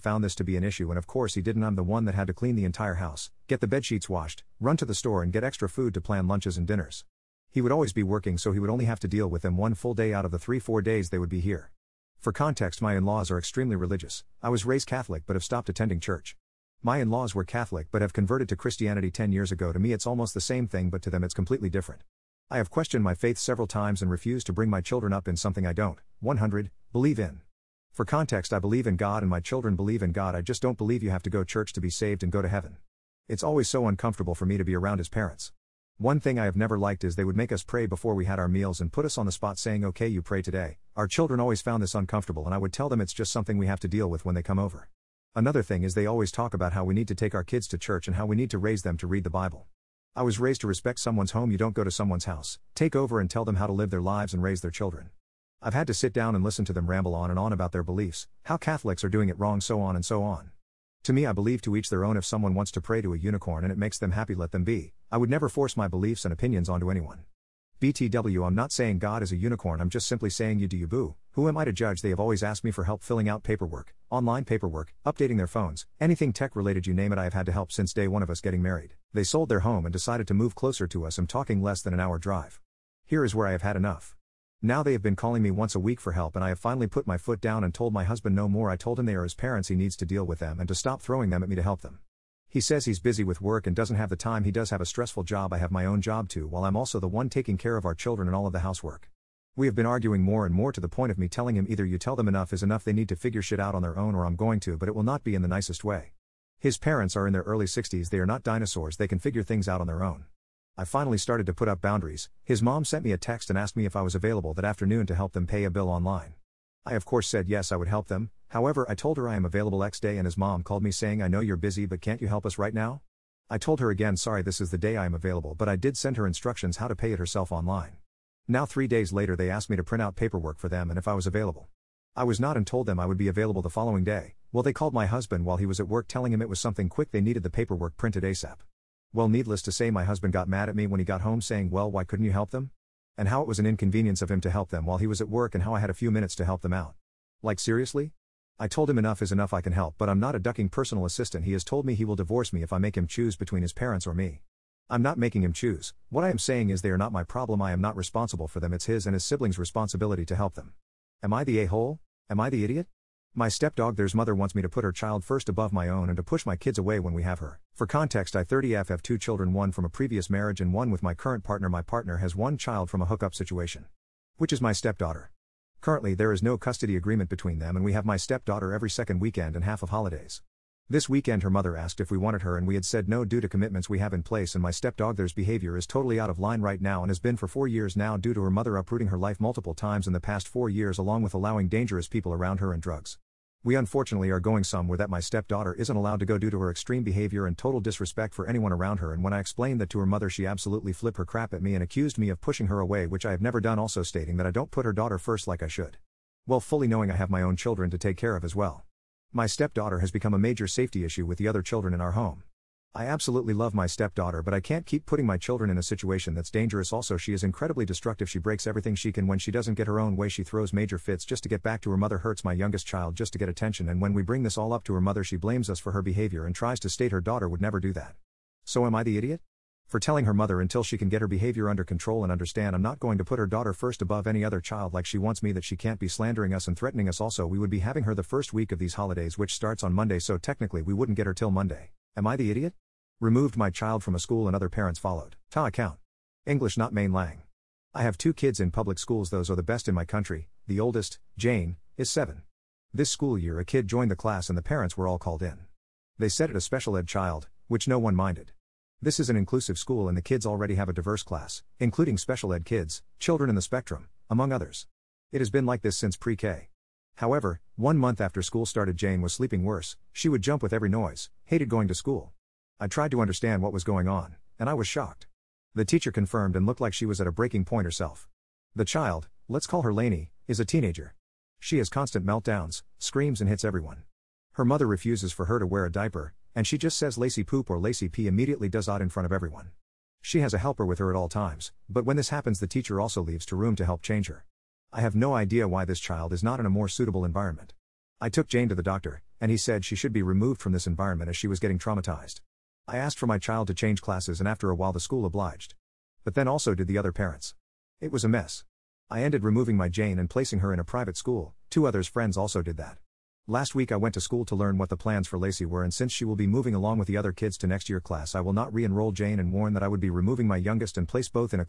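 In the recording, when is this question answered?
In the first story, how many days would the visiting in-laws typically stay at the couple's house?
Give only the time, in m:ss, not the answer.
0:10.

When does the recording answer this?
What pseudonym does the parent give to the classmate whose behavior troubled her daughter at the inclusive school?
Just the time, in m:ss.
4:39.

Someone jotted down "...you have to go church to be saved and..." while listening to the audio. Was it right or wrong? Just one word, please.
right.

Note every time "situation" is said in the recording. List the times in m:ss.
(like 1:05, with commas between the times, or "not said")
2:53, 3:35.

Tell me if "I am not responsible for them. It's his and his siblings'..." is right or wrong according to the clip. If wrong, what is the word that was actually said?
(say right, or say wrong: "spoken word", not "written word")
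right.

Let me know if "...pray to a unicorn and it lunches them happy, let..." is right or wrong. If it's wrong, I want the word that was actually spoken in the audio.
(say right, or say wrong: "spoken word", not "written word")
wrong: "makes", not "lunches".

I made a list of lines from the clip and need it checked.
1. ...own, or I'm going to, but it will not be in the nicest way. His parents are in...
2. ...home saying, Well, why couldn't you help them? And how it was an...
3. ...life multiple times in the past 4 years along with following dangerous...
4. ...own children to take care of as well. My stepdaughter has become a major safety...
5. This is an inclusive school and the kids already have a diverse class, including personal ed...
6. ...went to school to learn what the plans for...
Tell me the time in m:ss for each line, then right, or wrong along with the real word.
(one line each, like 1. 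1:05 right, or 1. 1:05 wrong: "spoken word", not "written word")
1. 1:43 right
2. 2:21 right
3. 3:09 wrong: "allowing", not "following"
4. 3:27 right
5. 4:19 wrong: "special", not "personal"
6. 5:13 right.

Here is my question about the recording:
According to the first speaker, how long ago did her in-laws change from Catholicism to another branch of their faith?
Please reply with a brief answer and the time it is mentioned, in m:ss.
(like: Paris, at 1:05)
10 years ago, at 0:19.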